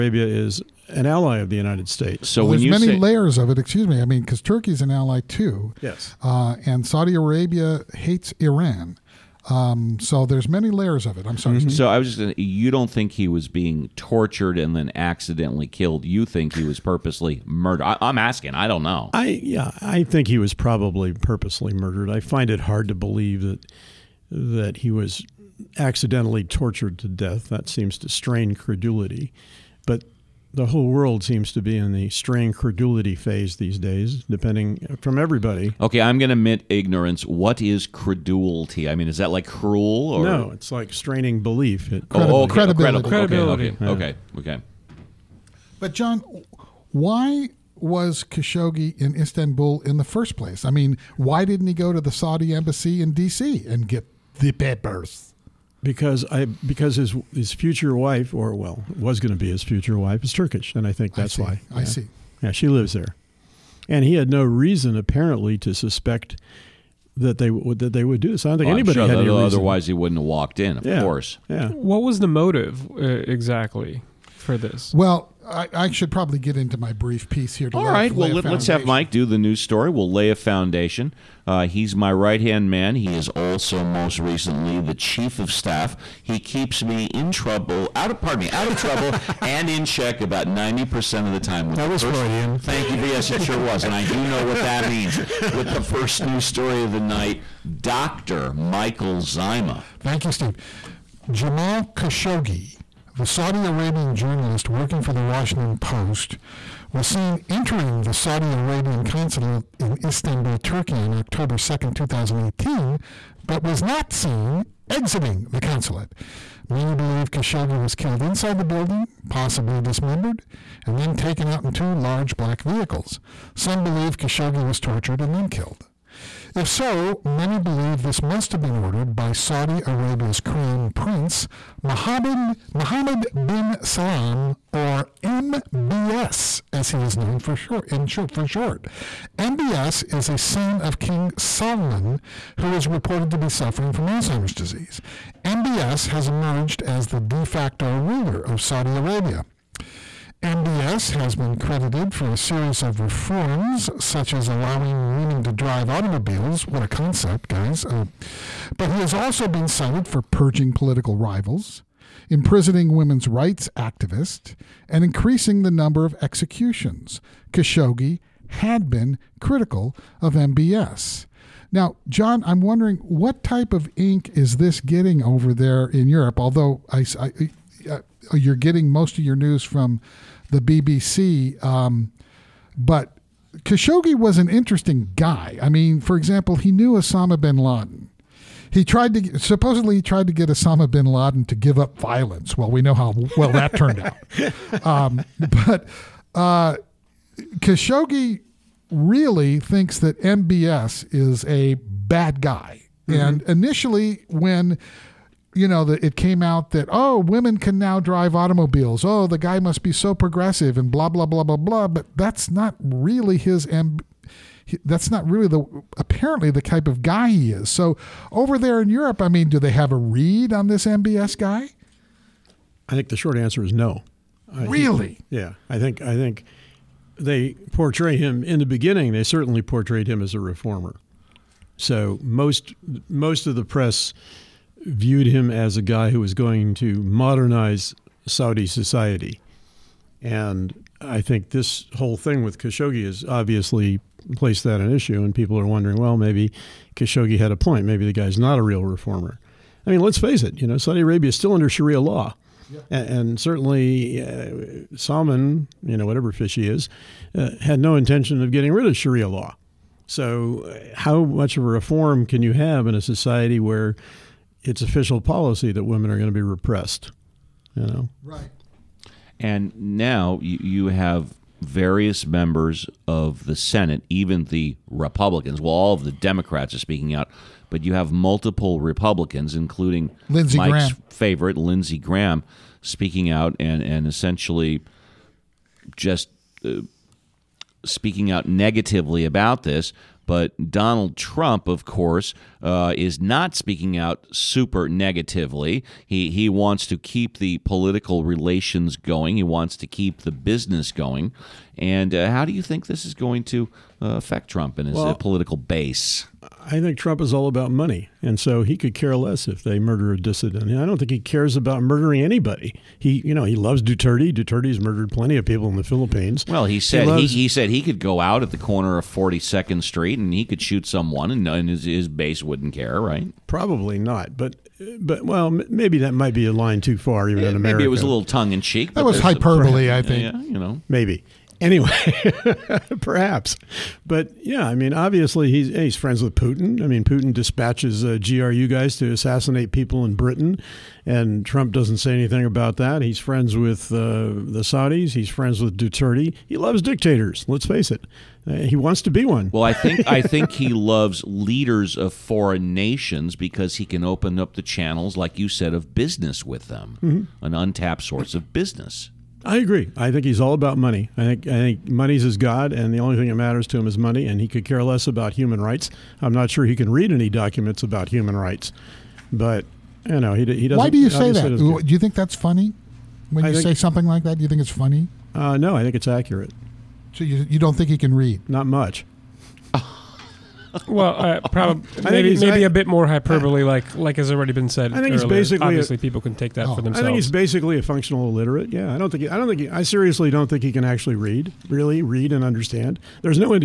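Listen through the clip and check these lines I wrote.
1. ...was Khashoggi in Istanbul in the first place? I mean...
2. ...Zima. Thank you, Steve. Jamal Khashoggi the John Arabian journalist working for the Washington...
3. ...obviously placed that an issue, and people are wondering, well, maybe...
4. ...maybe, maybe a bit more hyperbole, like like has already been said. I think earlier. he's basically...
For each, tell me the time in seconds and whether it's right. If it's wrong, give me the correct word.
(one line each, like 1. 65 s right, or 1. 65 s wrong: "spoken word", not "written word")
1. 47 s right
2. 99 s wrong: "Saudi", not "John"
3. 243 s right
4. 382 s right.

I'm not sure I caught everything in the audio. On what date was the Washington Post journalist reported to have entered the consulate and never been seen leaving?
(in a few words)
October 2nd, 2018.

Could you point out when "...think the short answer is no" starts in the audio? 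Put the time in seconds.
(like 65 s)
222 s.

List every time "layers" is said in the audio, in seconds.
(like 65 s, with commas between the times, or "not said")
2 s, 10 s.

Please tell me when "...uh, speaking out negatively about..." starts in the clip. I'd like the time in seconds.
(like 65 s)
286 s.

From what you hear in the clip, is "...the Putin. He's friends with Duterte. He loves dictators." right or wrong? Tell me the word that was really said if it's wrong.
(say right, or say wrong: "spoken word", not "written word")
wrong: "Saudis", not "Putin".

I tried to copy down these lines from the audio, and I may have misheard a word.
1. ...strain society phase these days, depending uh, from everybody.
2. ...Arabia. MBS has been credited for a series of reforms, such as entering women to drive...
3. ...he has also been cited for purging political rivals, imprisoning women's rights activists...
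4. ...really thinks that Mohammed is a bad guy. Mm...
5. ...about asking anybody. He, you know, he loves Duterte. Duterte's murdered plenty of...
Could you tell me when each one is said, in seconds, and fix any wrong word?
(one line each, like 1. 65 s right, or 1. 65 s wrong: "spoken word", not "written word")
1. 32 s wrong: "credulity", not "society"
2. 148 s wrong: "allowing", not "entering"
3. 158 s right
4. 198 s wrong: "MBS", not "Mohammed"
5. 311 s wrong: "murdering", not "asking".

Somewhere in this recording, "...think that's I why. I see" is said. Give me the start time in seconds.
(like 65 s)
60 s.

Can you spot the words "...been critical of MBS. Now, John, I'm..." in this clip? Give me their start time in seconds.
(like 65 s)
168 s.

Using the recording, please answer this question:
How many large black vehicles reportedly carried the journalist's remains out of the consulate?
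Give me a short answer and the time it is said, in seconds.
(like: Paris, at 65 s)
2, at 121 s.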